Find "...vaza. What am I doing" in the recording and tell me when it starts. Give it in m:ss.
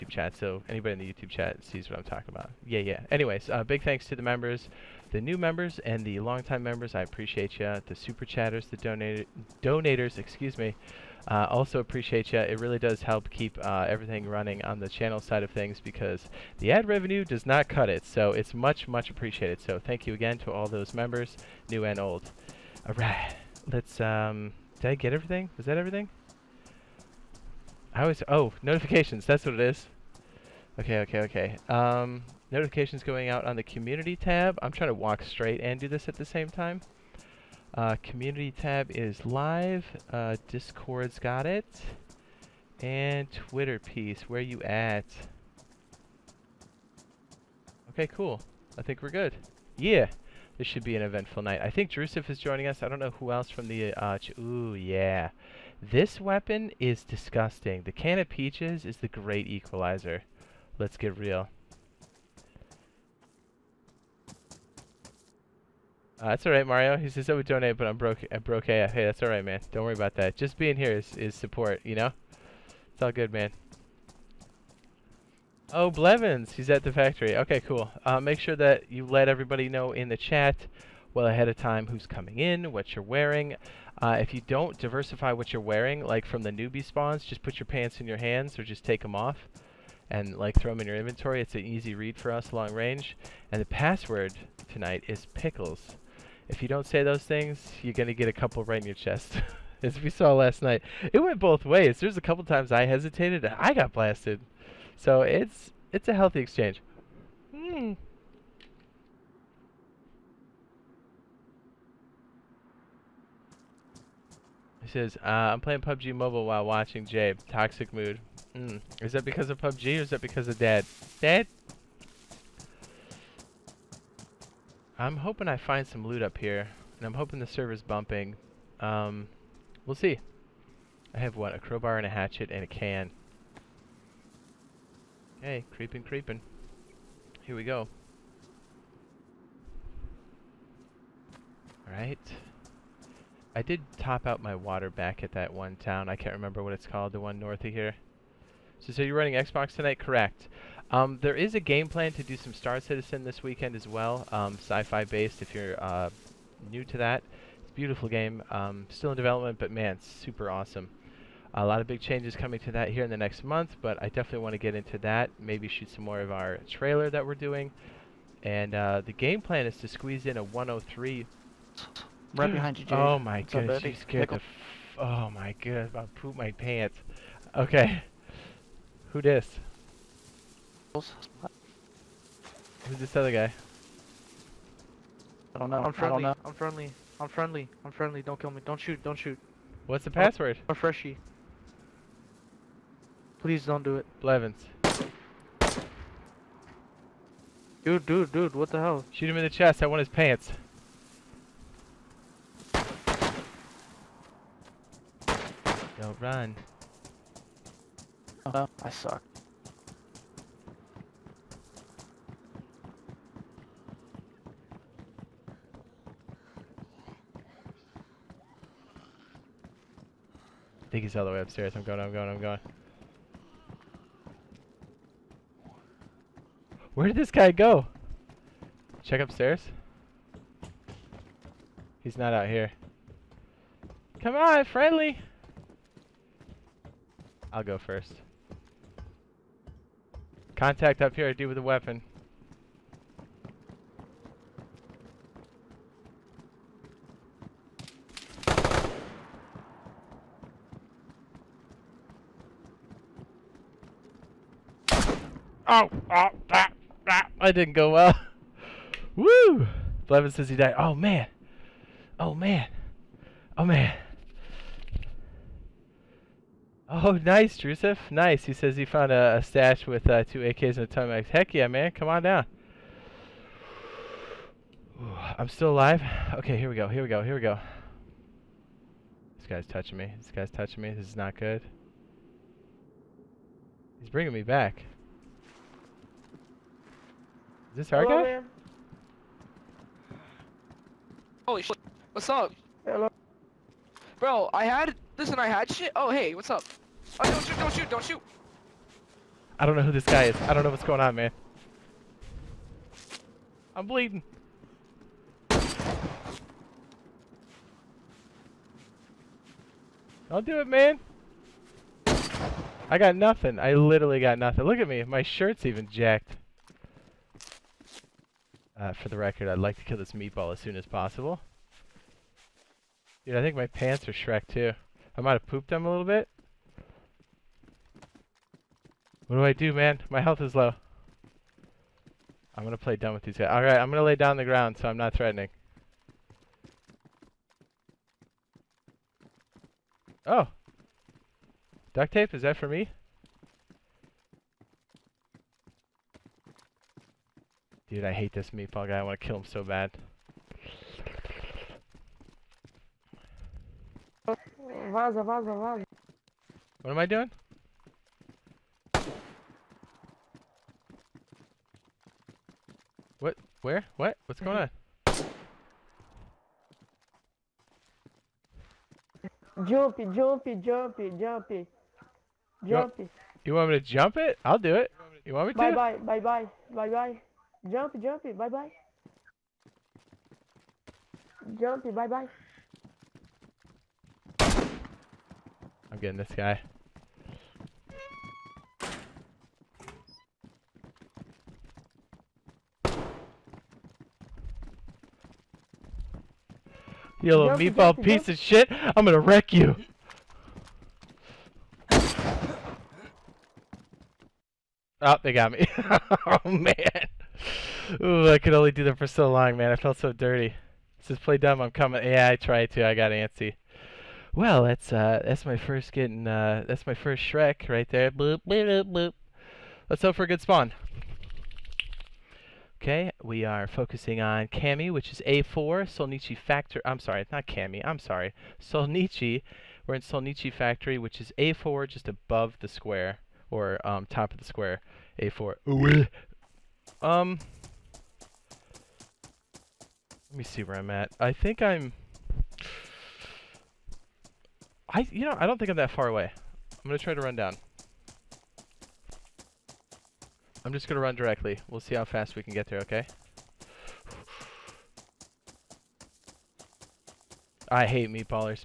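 5:55.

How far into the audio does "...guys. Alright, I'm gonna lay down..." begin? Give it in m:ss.
5:33.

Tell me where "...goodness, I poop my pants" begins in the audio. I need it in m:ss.
2:55.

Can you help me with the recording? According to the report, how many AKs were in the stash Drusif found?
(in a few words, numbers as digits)
2.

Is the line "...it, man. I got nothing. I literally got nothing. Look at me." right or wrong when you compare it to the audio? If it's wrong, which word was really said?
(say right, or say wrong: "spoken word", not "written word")
right.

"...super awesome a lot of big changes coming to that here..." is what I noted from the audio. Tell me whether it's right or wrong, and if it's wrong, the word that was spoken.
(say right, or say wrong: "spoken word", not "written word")
right.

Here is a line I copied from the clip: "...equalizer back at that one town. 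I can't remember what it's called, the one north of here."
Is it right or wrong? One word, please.
wrong.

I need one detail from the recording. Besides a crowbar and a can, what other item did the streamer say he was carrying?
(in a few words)
a hatchet.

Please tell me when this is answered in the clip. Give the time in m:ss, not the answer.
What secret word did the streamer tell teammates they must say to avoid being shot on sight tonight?
1:33.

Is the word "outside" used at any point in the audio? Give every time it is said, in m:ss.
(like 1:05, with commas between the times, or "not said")
not said.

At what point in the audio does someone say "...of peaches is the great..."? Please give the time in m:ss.
0:58.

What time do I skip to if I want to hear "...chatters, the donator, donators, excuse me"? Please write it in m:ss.
0:08.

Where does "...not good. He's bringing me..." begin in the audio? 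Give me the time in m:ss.
4:41.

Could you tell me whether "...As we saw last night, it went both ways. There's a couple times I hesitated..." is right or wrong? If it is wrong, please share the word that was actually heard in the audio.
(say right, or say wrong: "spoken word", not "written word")
right.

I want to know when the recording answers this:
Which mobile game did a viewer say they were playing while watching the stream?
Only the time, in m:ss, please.
1:55.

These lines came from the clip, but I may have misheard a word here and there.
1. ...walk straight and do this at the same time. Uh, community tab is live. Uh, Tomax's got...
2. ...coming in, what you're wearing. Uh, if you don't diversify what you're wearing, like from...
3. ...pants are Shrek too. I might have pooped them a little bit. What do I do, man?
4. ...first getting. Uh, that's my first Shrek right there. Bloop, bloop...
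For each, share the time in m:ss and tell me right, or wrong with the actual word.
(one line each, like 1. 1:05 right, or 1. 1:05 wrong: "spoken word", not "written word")
1. 0:34 wrong: "Discord", not "Tomax"
2. 1:22 right
3. 5:23 right
4. 6:55 right.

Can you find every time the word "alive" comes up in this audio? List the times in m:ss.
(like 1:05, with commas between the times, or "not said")
4:35.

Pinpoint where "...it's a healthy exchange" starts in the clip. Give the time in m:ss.
1:45.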